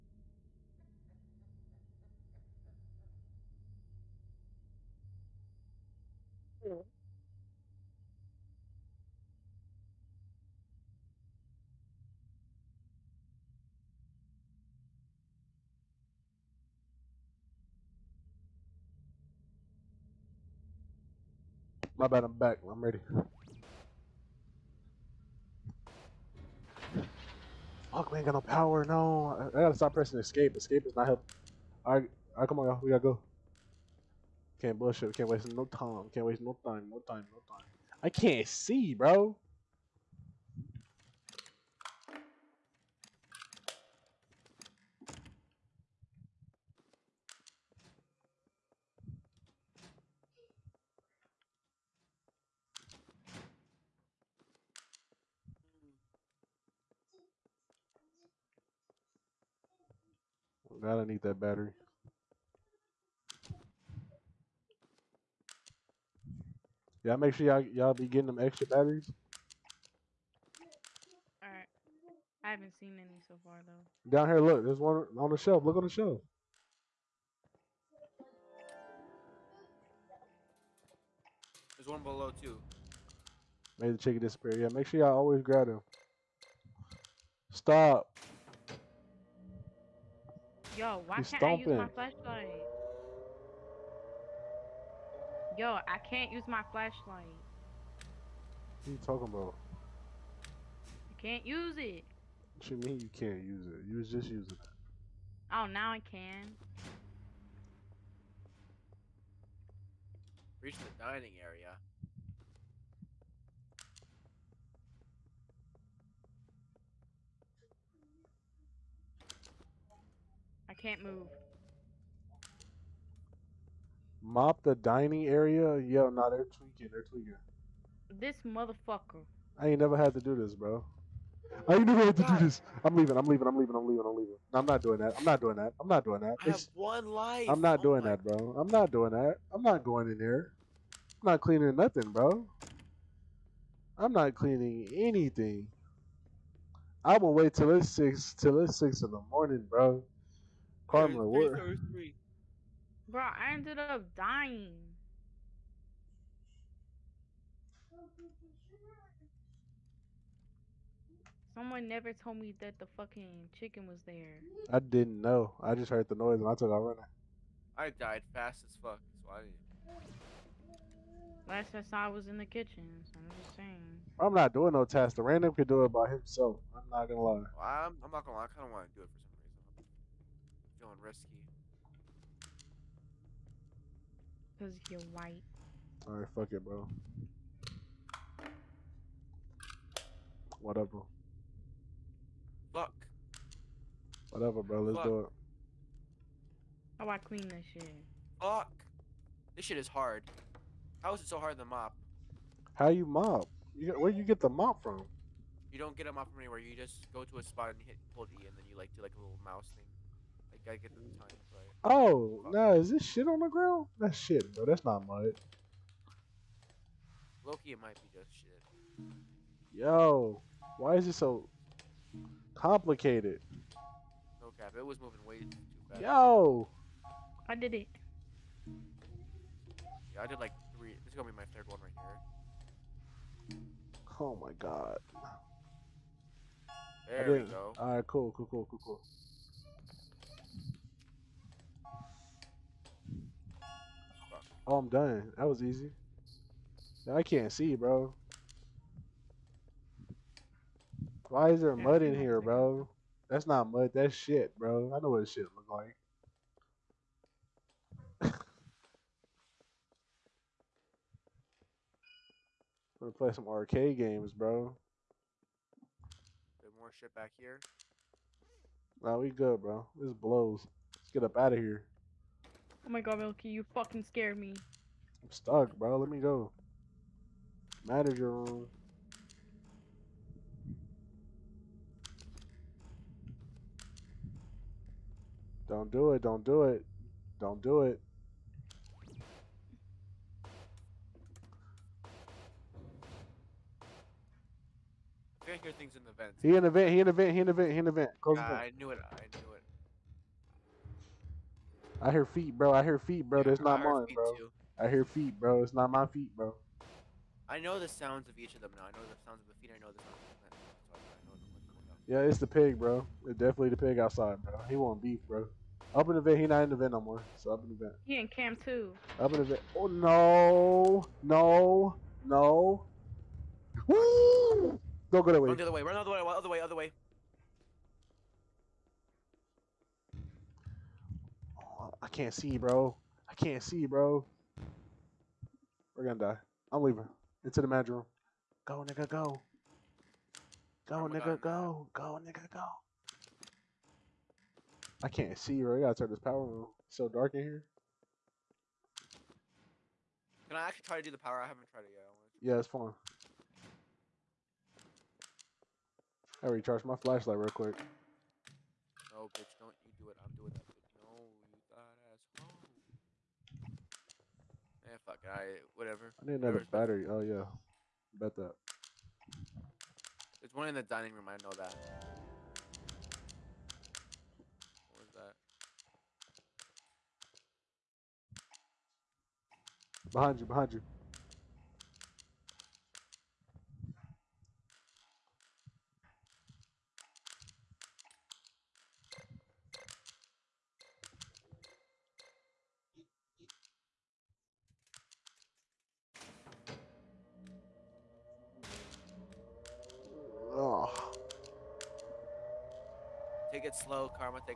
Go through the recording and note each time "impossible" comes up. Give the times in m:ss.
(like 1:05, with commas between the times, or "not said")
not said.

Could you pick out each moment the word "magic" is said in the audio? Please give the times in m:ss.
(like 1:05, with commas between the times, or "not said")
5:37.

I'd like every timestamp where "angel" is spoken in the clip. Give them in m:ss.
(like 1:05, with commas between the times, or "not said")
not said.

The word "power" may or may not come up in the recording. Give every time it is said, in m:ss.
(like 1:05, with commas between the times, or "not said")
0:28, 5:46, 5:51.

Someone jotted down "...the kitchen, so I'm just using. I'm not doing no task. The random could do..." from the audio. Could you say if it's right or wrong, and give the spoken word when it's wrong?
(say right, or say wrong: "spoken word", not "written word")
wrong: "saying", not "using".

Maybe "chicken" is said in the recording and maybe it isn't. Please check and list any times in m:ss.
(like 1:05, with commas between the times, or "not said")
1:23, 2:43.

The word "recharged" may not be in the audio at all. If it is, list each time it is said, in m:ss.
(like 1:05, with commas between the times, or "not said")
5:56.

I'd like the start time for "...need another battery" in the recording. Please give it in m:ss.
6:06.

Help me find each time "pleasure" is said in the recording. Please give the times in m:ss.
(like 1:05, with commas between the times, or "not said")
not said.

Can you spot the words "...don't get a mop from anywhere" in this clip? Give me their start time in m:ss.
3:25.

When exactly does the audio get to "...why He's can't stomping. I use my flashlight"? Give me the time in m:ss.
1:31.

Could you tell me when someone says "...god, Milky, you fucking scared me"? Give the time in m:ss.
4:33.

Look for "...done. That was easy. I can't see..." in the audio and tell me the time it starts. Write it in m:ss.
4:04.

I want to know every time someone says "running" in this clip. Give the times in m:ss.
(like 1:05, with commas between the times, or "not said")
2:46.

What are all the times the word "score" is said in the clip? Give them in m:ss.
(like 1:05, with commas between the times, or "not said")
not said.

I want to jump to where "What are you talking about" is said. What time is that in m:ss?
1:37.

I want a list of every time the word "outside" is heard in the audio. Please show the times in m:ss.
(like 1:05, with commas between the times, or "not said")
5:13.